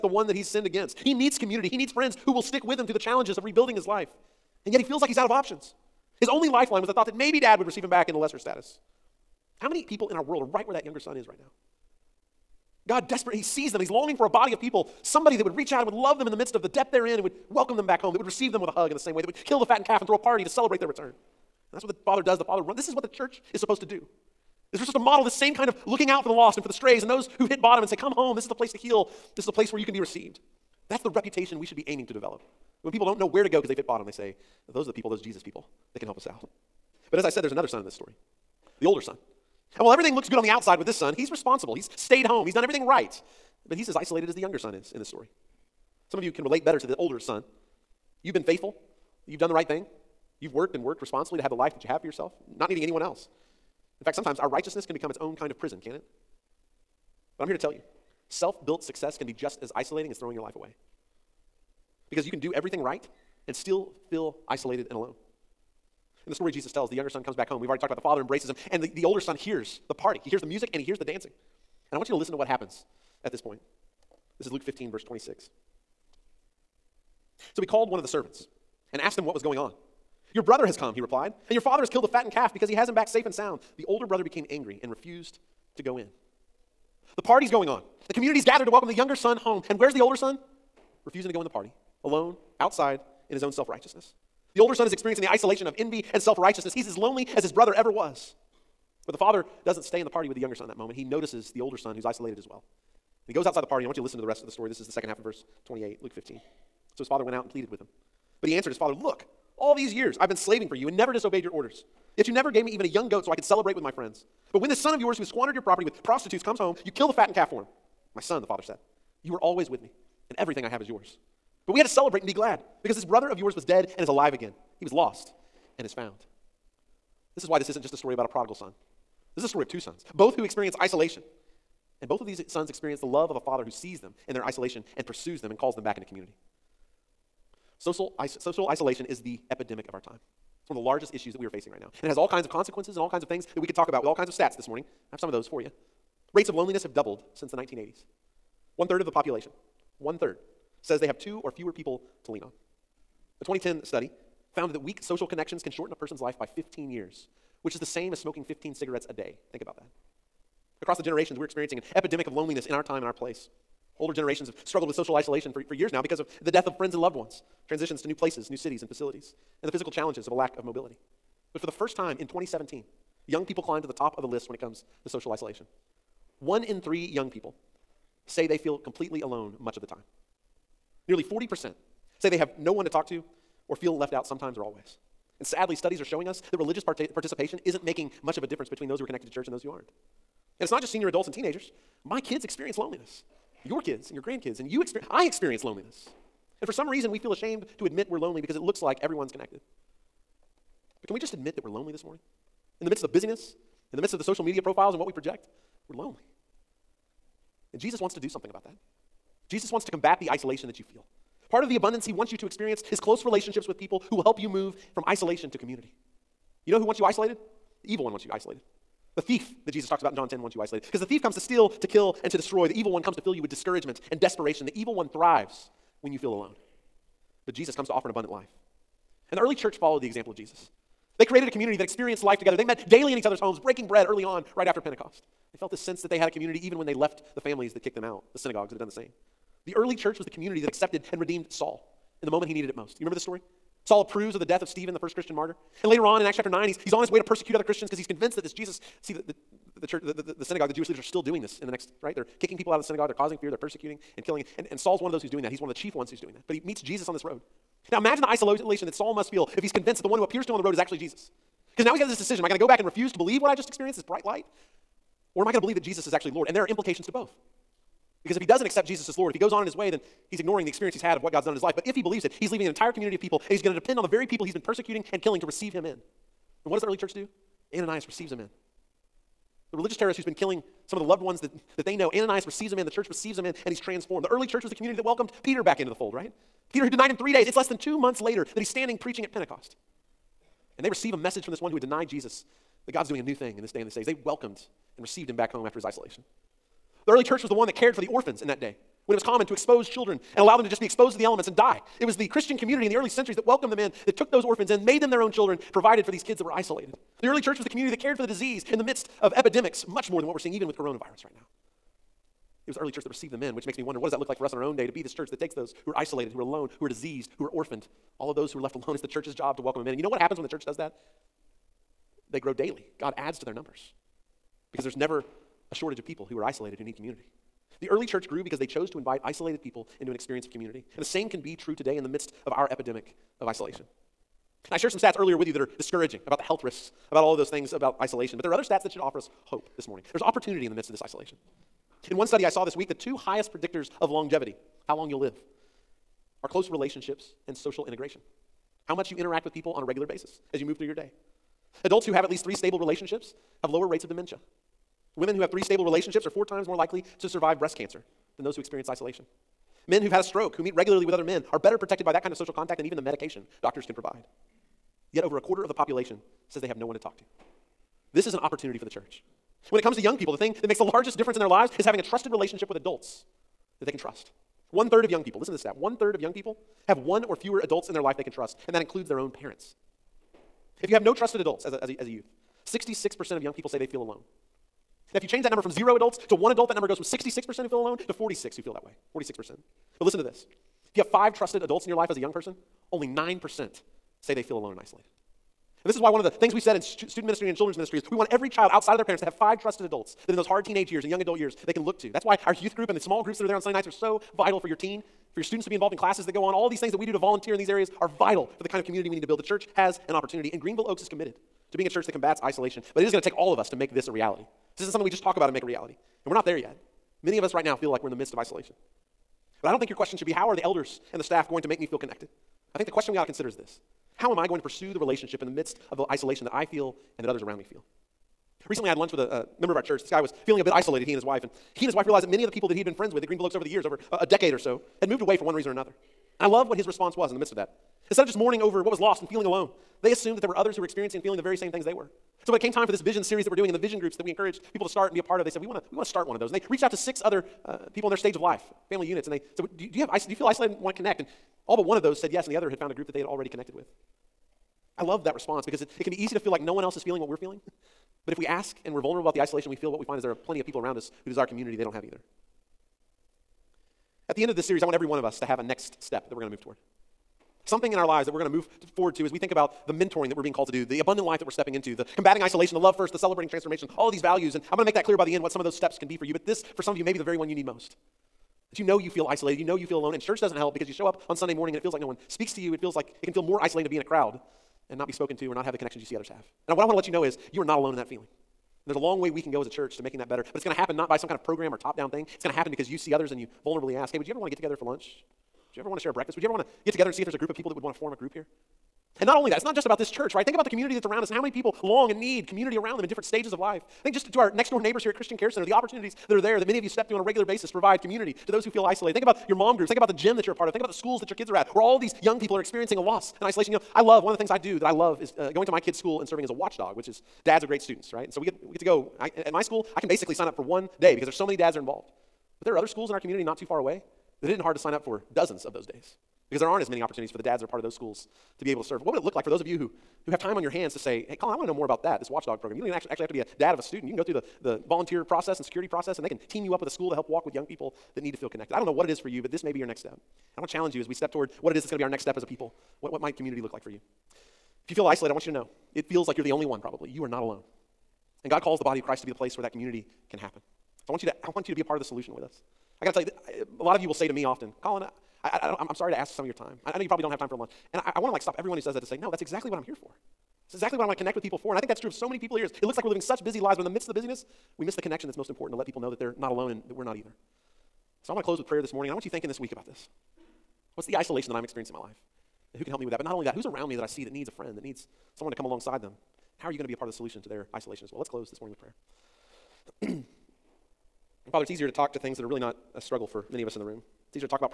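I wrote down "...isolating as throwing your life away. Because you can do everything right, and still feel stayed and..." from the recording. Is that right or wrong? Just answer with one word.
wrong.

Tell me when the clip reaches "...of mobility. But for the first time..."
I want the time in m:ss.
2:50.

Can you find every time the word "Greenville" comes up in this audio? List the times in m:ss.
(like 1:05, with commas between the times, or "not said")
6:50, 7:13.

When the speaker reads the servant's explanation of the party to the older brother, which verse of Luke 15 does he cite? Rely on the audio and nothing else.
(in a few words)
26.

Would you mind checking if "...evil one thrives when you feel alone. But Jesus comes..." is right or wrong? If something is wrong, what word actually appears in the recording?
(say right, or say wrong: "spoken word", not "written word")
right.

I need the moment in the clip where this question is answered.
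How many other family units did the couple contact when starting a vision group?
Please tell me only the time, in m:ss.
7:26.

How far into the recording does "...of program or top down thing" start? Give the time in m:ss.
8:11.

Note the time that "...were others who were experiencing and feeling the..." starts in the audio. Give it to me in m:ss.
7:20.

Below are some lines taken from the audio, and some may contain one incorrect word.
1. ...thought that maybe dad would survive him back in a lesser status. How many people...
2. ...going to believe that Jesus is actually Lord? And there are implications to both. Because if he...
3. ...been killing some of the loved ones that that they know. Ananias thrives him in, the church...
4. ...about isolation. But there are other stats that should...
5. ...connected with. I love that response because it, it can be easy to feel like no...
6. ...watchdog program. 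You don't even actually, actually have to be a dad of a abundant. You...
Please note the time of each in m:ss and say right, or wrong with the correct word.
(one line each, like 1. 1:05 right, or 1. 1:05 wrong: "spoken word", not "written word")
1. 0:06 wrong: "receive", not "survive"
2. 4:25 right
3. 4:40 wrong: "receives", not "thrives"
4. 5:37 right
5. 7:33 right
6. 8:52 wrong: "student", not "abundant".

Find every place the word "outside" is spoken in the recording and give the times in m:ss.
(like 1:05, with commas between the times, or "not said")
0:40, 1:32, 1:43, 6:38.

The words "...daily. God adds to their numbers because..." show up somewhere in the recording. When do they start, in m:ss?
5:22.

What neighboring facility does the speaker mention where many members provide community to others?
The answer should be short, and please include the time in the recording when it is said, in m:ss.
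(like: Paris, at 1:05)
Christian Care Center, at 8:25.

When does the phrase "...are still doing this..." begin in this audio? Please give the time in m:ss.
4:10.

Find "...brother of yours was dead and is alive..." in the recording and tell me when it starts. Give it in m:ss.
2:03.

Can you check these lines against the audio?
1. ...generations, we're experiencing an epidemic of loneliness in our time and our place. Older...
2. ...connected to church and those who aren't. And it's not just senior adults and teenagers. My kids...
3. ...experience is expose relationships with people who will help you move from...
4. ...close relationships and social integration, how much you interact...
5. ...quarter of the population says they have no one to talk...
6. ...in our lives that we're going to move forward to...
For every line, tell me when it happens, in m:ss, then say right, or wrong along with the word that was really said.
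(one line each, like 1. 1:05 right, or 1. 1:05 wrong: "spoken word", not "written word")
1. 2:41 right
2. 3:09 right
3. 3:32 wrong: "close", not "expose"
4. 5:46 right
5. 6:05 right
6. 7:47 right.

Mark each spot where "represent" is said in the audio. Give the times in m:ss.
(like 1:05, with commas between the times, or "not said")
not said.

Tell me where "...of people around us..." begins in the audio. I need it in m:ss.
7:40.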